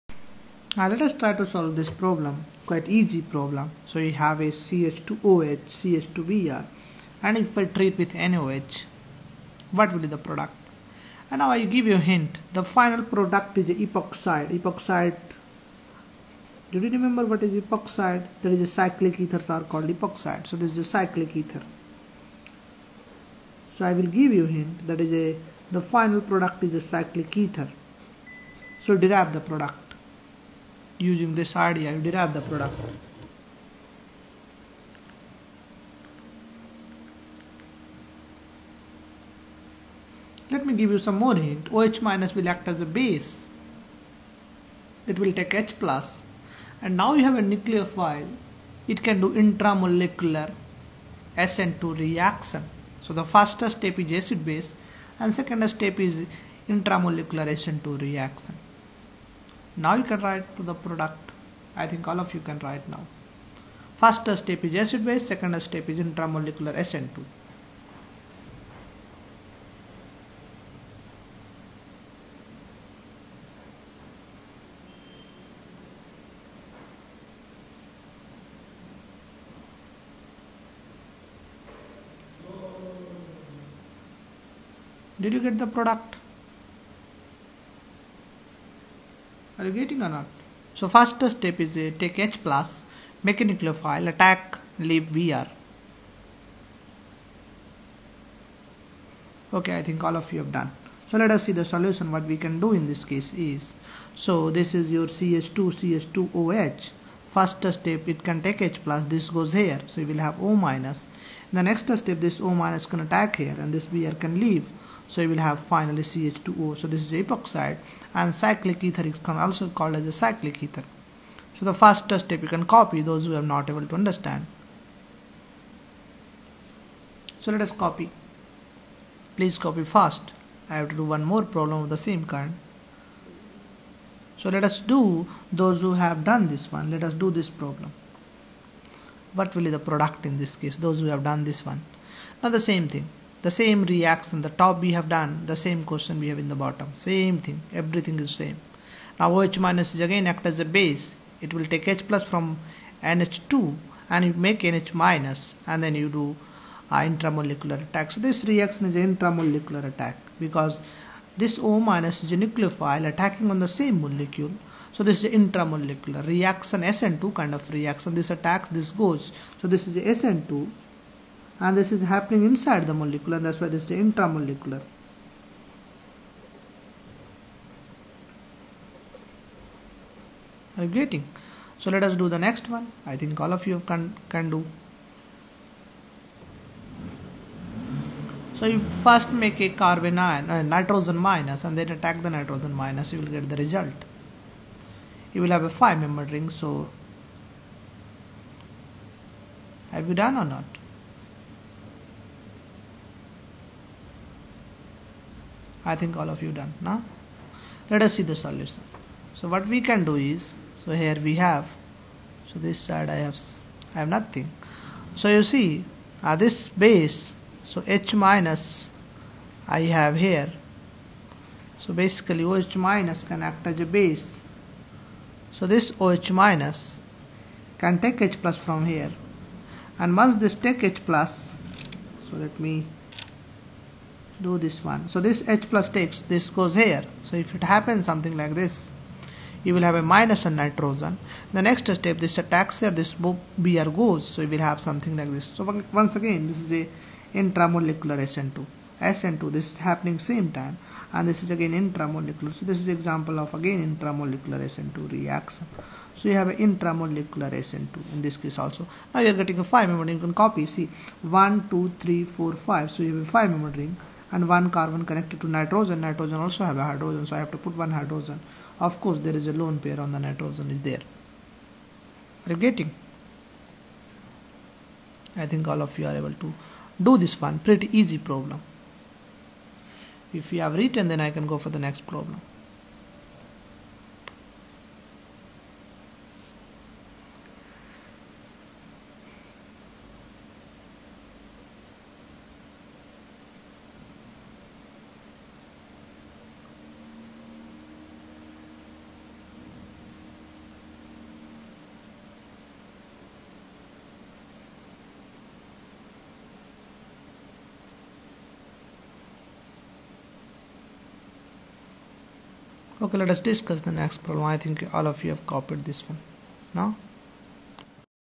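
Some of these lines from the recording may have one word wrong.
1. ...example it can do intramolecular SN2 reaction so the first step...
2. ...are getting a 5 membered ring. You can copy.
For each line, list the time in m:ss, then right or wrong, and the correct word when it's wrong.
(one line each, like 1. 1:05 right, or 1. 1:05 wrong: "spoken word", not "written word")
1. 0:47 wrong: "nucleophile", not "example"
2. 4:19 right.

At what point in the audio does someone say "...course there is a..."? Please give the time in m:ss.
4:29.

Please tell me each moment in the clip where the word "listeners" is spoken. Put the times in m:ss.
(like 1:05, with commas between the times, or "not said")
not said.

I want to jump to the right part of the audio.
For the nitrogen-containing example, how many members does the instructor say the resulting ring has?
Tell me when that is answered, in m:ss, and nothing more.
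3:15.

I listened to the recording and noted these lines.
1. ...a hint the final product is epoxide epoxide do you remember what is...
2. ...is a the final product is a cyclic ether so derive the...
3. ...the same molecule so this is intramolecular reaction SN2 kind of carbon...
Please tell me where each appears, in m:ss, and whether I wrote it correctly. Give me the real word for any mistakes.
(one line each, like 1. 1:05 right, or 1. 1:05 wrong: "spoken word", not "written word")
1. 0:11 right
2. 0:25 right
3. 2:43 wrong: "reaction", not "carbon".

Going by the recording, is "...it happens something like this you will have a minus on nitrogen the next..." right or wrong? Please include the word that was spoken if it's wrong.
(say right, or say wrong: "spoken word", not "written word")
right.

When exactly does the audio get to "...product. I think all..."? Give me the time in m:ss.
1:00.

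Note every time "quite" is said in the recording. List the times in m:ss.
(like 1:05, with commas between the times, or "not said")
0:02.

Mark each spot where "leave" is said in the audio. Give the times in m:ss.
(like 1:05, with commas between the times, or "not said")
1:34, 1:54.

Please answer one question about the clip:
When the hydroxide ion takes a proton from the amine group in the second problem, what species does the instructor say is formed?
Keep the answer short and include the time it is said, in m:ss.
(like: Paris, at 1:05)
NH minus, at 2:34.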